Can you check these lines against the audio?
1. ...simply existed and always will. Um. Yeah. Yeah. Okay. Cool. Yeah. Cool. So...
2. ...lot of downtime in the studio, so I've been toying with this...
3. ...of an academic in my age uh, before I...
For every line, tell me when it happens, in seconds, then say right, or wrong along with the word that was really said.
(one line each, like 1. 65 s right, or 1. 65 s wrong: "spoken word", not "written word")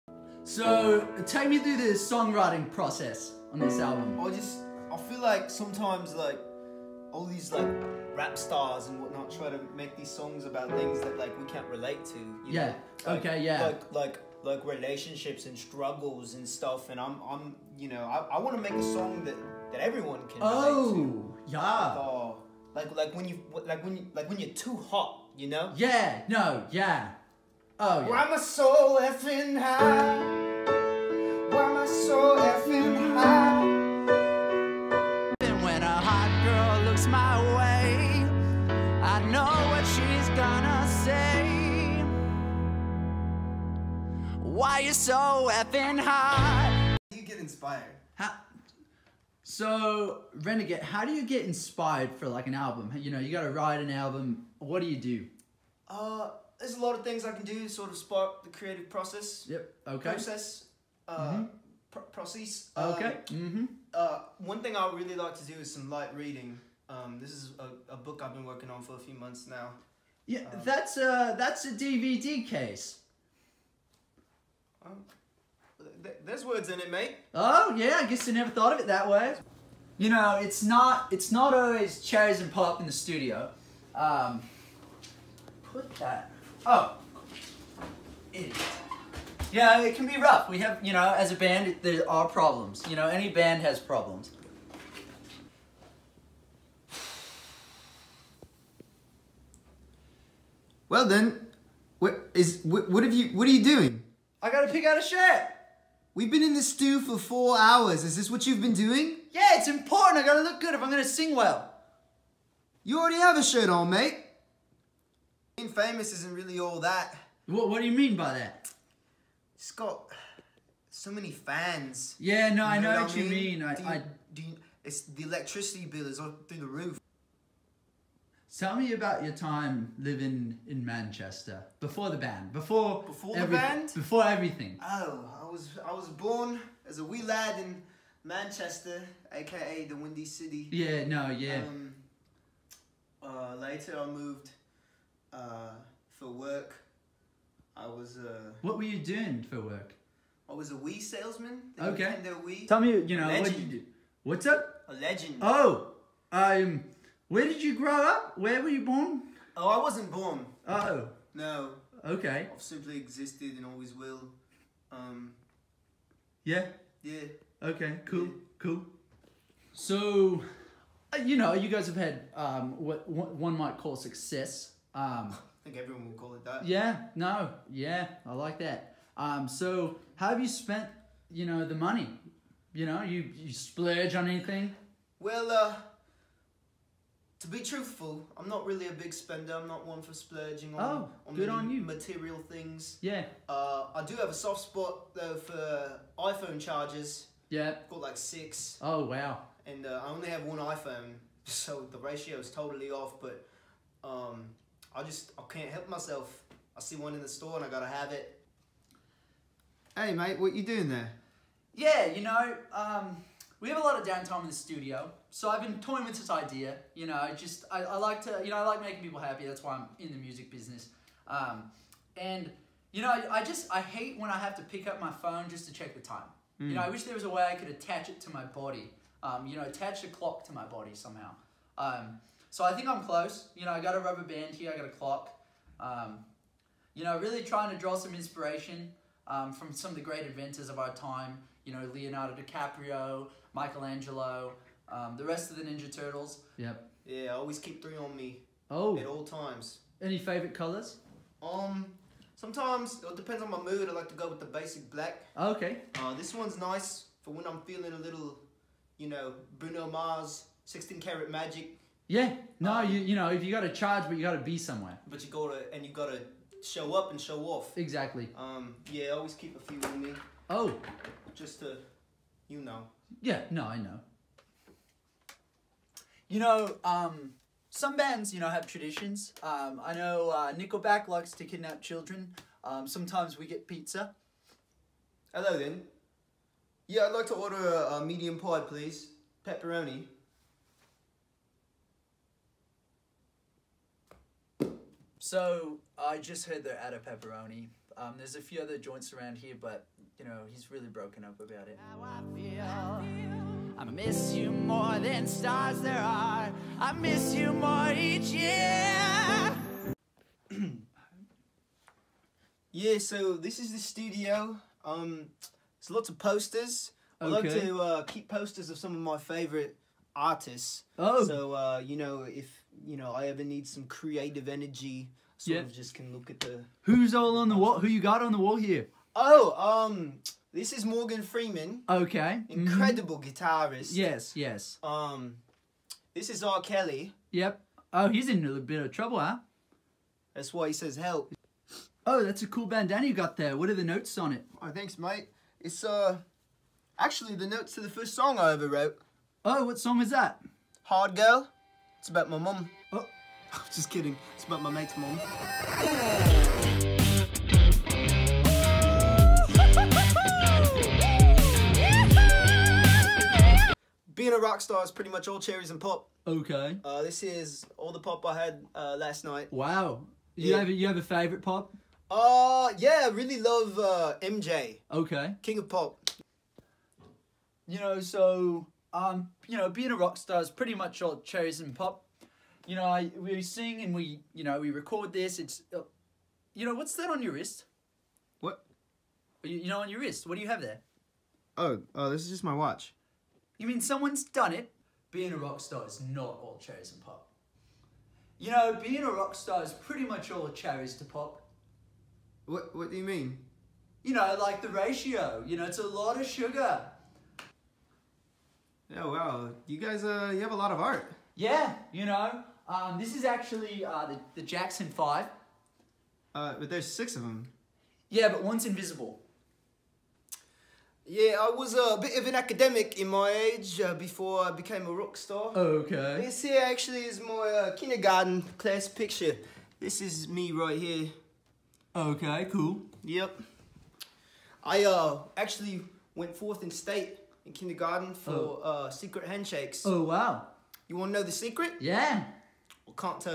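1. 162 s right
2. 213 s right
3. 422 s right.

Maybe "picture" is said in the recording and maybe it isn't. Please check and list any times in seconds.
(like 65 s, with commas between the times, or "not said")
428 s.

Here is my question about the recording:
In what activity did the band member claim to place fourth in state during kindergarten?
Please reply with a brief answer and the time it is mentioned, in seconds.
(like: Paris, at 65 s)
Secret handshakes, at 438 s.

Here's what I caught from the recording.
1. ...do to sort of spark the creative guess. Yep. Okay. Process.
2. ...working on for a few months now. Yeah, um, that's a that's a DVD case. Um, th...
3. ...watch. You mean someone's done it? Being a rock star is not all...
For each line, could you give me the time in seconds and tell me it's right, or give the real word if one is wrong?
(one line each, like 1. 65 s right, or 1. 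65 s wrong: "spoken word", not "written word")
1. 57 s wrong: "process", not "guess"
2. 68 s right
3. 392 s right.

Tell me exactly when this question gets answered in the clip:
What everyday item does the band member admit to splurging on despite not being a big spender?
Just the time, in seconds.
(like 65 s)
196 s.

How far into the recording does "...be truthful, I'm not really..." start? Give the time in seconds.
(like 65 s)
187 s.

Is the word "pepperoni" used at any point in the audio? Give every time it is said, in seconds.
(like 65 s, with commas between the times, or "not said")
289 s, 297 s.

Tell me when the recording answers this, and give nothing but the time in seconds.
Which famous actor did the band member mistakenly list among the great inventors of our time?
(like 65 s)
241 s.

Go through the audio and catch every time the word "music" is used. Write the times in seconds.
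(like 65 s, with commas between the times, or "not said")
220 s.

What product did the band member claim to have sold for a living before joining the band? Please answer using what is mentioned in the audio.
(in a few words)
Nintendo Wii.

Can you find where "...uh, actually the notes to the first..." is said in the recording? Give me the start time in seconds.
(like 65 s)
345 s.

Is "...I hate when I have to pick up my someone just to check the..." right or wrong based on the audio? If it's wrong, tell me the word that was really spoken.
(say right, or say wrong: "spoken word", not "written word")
wrong: "phone", not "someone".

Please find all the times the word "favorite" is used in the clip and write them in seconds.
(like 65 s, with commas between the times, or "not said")
250 s, 319 s, 371 s.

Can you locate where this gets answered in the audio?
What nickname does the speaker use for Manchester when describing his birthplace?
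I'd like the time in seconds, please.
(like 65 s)
139 s.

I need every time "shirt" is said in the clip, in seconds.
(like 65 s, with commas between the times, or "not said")
105 s, 113 s.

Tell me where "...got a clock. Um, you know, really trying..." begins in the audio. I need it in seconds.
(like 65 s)
234 s.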